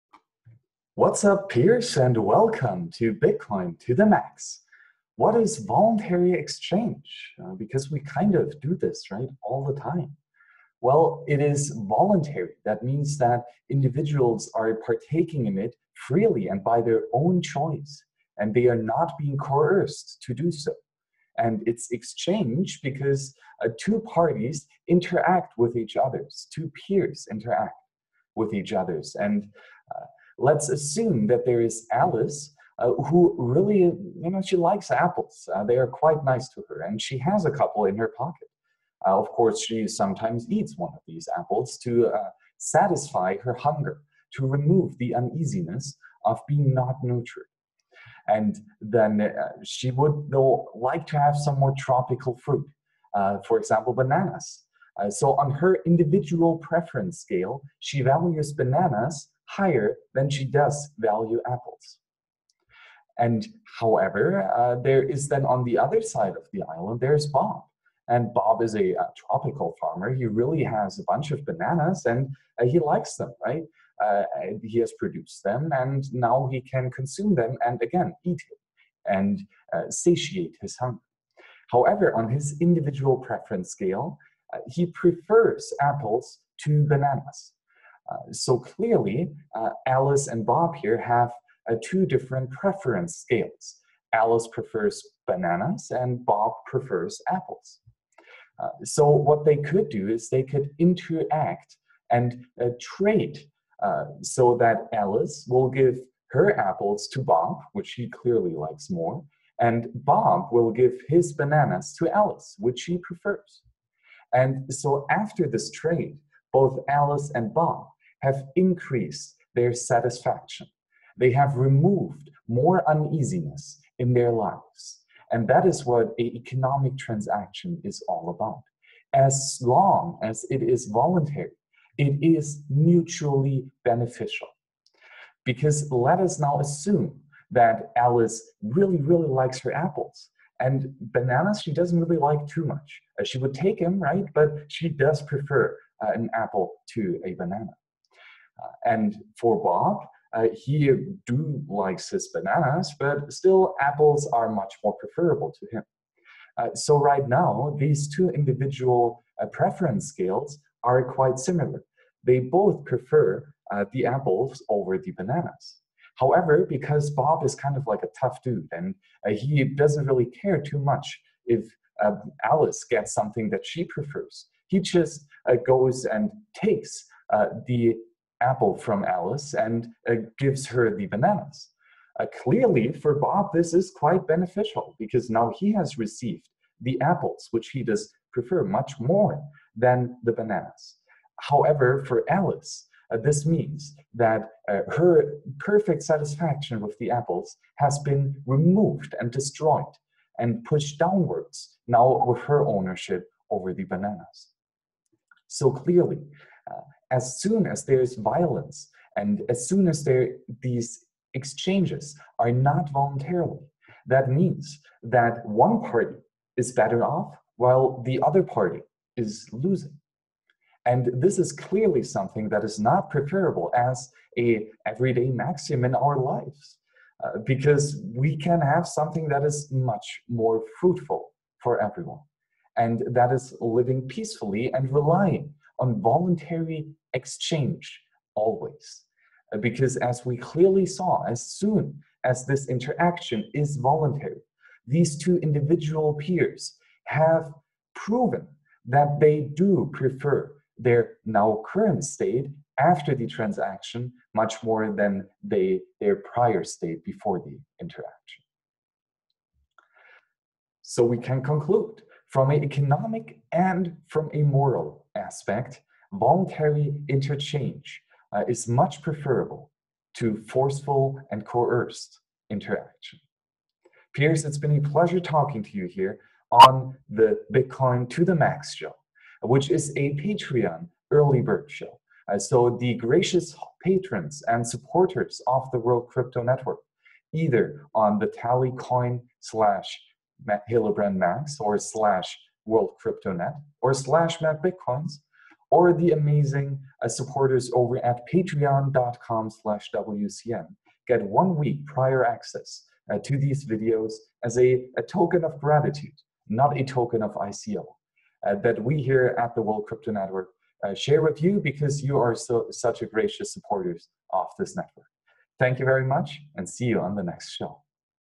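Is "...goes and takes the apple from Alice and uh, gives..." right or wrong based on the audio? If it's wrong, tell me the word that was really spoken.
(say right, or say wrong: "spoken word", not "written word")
right.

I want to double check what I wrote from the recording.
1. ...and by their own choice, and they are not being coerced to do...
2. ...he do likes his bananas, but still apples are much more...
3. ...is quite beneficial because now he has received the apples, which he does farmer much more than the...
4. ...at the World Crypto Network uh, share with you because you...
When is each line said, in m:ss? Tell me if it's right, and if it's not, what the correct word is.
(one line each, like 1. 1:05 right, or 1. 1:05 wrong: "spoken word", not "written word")
1. 0:16 right
2. 2:30 right
3. 3:03 wrong: "prefer", not "farmer"
4. 5:09 right.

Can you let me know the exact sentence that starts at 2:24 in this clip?
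But she does prefer uh, an apple to a banana.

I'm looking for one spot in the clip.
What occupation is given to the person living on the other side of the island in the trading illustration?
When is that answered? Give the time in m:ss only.
1:08.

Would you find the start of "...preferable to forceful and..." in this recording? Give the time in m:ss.
4:29.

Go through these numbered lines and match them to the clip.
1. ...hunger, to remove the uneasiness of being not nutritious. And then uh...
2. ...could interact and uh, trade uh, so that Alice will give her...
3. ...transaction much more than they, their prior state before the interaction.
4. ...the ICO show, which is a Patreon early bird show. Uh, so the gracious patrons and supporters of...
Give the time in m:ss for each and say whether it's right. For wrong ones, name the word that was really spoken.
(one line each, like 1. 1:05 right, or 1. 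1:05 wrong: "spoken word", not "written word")
1. 0:43 right
2. 1:40 right
3. 4:13 right
4. 4:38 wrong: "Max", not "ICO".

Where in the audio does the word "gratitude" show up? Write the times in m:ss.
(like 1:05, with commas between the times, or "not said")
5:05.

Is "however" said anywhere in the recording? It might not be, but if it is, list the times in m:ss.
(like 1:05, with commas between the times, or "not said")
1:03, 1:21, 2:46, 3:11.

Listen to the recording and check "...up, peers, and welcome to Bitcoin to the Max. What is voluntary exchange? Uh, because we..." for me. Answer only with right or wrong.
right.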